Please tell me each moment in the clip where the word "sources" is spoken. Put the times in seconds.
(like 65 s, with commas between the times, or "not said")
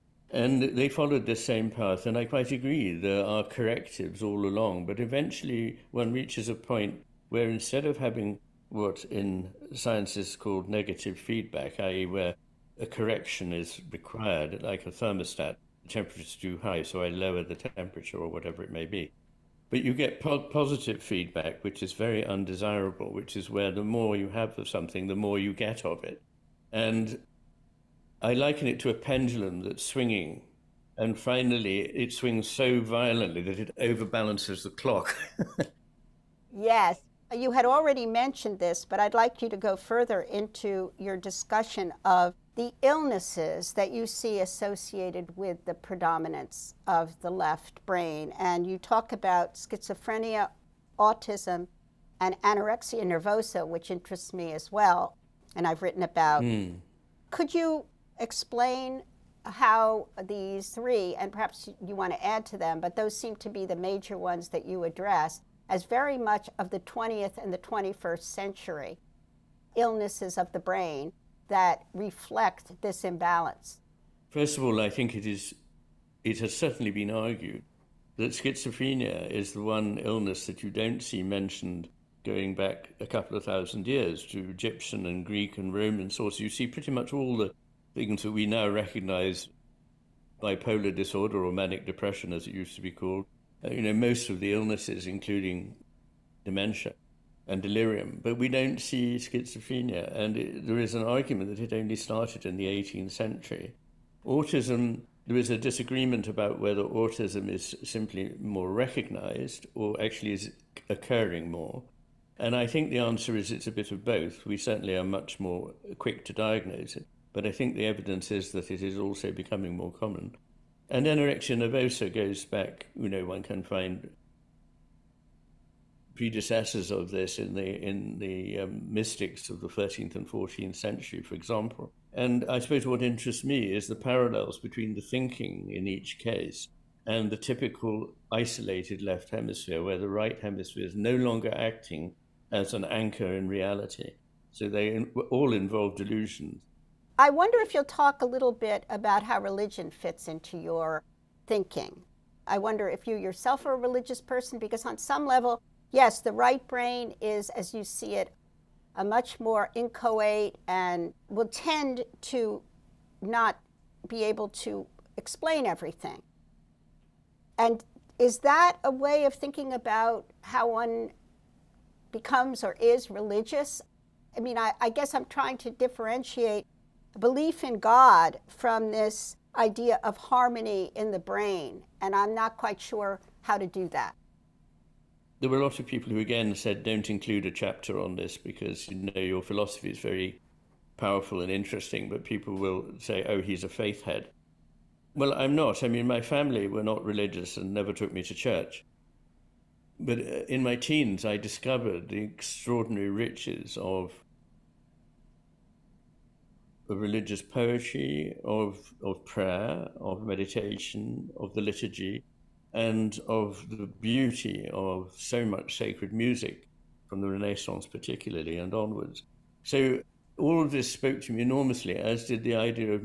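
86 s.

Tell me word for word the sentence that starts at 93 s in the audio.
Uh, you know, most of the illnesses, including dementia and delirium, but we don't see schizophrenia.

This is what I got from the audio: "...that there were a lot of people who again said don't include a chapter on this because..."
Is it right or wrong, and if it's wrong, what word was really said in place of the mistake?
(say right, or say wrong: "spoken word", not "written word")
right.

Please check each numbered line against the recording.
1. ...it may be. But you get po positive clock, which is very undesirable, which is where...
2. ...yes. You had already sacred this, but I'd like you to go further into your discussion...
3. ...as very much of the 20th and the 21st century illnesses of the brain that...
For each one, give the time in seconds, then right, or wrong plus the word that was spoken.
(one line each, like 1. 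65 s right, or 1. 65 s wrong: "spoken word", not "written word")
1. 18 s wrong: "feedback", not "clock"
2. 36 s wrong: "mentioned", not "sacred"
3. 65 s right.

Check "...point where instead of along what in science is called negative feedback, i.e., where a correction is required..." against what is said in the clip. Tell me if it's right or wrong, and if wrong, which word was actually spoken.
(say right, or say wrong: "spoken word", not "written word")
wrong: "having", not "along".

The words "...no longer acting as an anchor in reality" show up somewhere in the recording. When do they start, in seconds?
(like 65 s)
141 s.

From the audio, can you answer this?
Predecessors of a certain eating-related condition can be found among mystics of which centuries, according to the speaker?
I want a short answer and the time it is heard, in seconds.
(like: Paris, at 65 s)
13th and 14th, at 129 s.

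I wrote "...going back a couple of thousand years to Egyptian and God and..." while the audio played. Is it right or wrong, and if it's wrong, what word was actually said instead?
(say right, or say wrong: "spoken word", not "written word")
wrong: "Greek", not "God".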